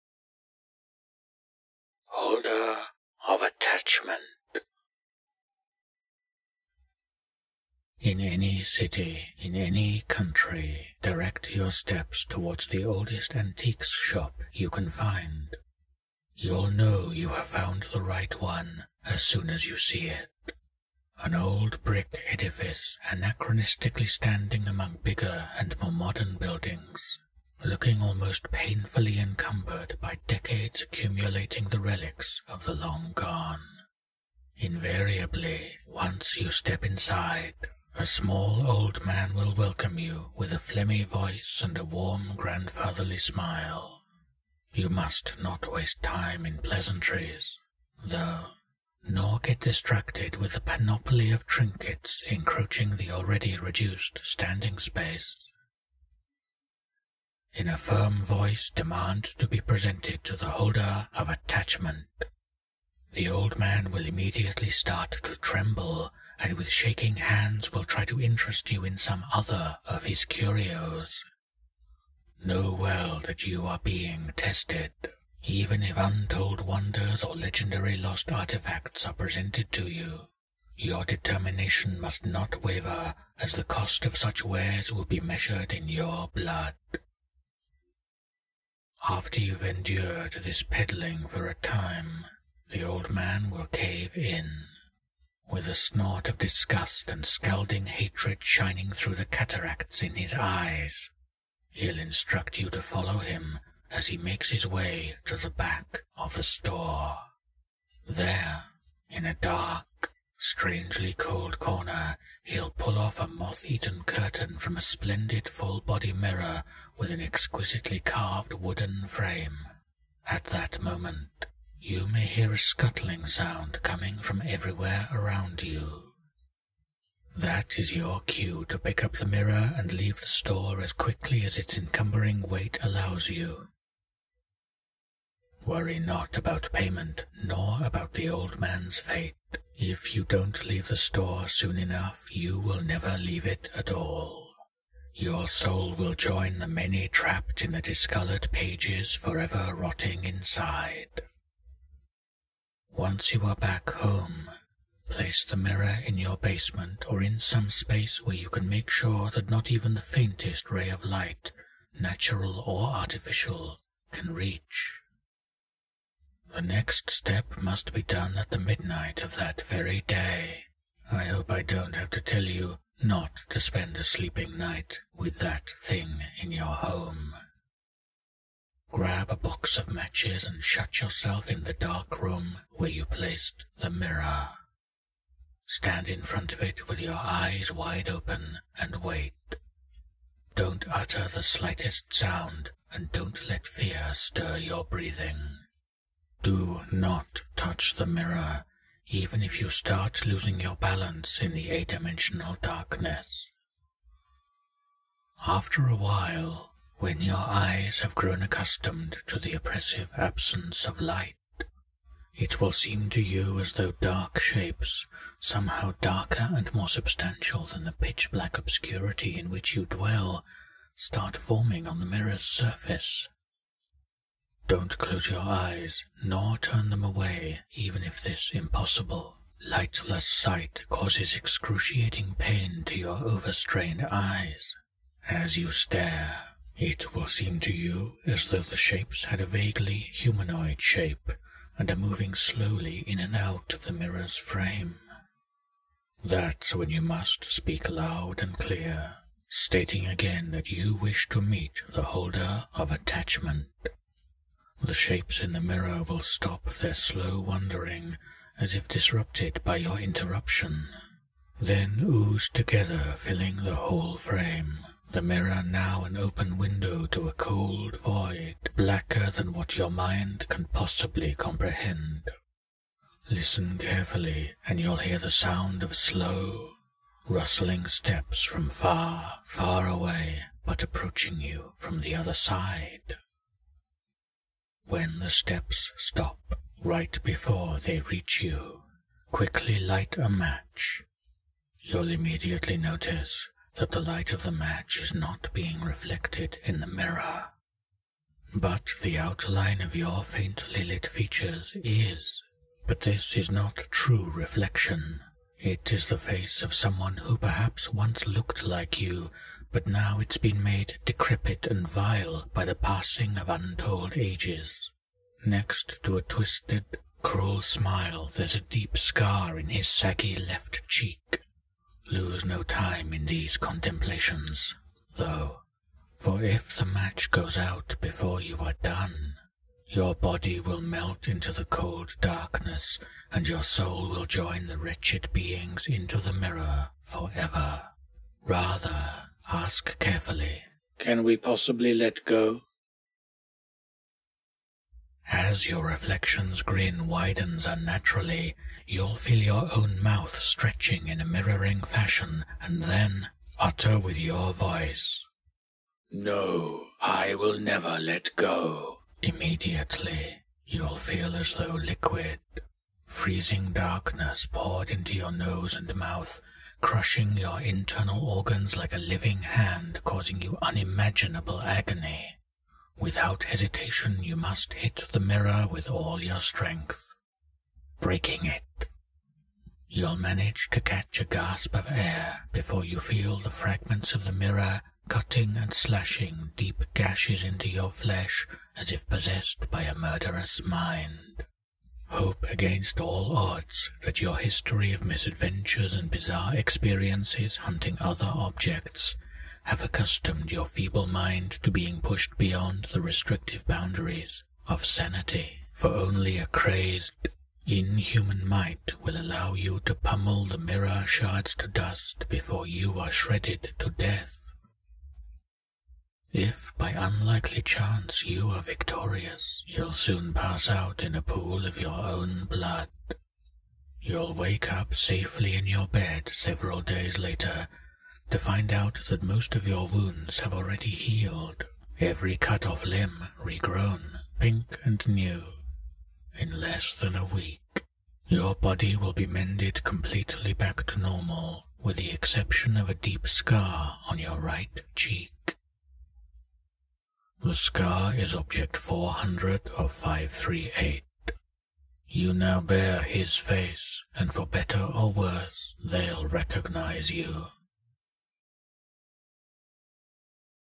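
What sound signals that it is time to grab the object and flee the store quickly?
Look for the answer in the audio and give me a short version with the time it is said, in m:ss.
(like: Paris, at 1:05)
a scuttling sound, at 2:02.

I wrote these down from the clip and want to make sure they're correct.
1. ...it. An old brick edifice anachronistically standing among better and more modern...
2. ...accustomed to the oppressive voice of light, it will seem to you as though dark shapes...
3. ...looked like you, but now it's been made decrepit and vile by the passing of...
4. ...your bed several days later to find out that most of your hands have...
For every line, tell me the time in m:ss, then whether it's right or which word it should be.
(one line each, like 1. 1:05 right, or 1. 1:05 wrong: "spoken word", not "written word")
1. 0:20 wrong: "bigger", not "better"
2. 3:28 wrong: "absence", not "voice"
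3. 5:08 right
4. 7:05 wrong: "wounds", not "hands".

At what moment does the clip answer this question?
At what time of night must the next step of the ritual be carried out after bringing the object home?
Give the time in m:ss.
2:48.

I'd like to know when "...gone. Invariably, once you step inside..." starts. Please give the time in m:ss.
0:33.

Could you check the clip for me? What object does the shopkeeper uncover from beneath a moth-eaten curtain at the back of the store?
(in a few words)
full-body mirror.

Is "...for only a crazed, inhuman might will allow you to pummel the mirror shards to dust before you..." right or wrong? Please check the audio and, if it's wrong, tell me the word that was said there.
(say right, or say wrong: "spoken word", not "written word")
right.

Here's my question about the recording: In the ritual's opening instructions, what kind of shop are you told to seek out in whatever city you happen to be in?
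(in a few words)
oldest antiques shop.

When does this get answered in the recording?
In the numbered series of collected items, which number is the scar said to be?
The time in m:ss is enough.
7:28.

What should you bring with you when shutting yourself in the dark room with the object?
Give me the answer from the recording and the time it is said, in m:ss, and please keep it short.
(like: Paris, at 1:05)
box of matches, at 2:59.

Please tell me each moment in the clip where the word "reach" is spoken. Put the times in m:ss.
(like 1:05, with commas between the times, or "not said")
2:44, 4:47.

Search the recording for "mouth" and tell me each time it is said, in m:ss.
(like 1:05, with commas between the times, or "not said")
5:50, 6:05.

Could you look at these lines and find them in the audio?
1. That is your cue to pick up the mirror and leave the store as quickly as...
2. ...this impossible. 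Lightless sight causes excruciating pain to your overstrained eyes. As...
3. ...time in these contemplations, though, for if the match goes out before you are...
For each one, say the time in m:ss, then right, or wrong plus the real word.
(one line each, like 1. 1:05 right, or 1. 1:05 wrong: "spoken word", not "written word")
1. 2:07 right
2. 3:48 right
3. 5:22 right.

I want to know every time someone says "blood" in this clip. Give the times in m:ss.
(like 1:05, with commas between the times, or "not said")
1:26, 7:02.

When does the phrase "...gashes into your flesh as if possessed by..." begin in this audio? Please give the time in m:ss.
6:26.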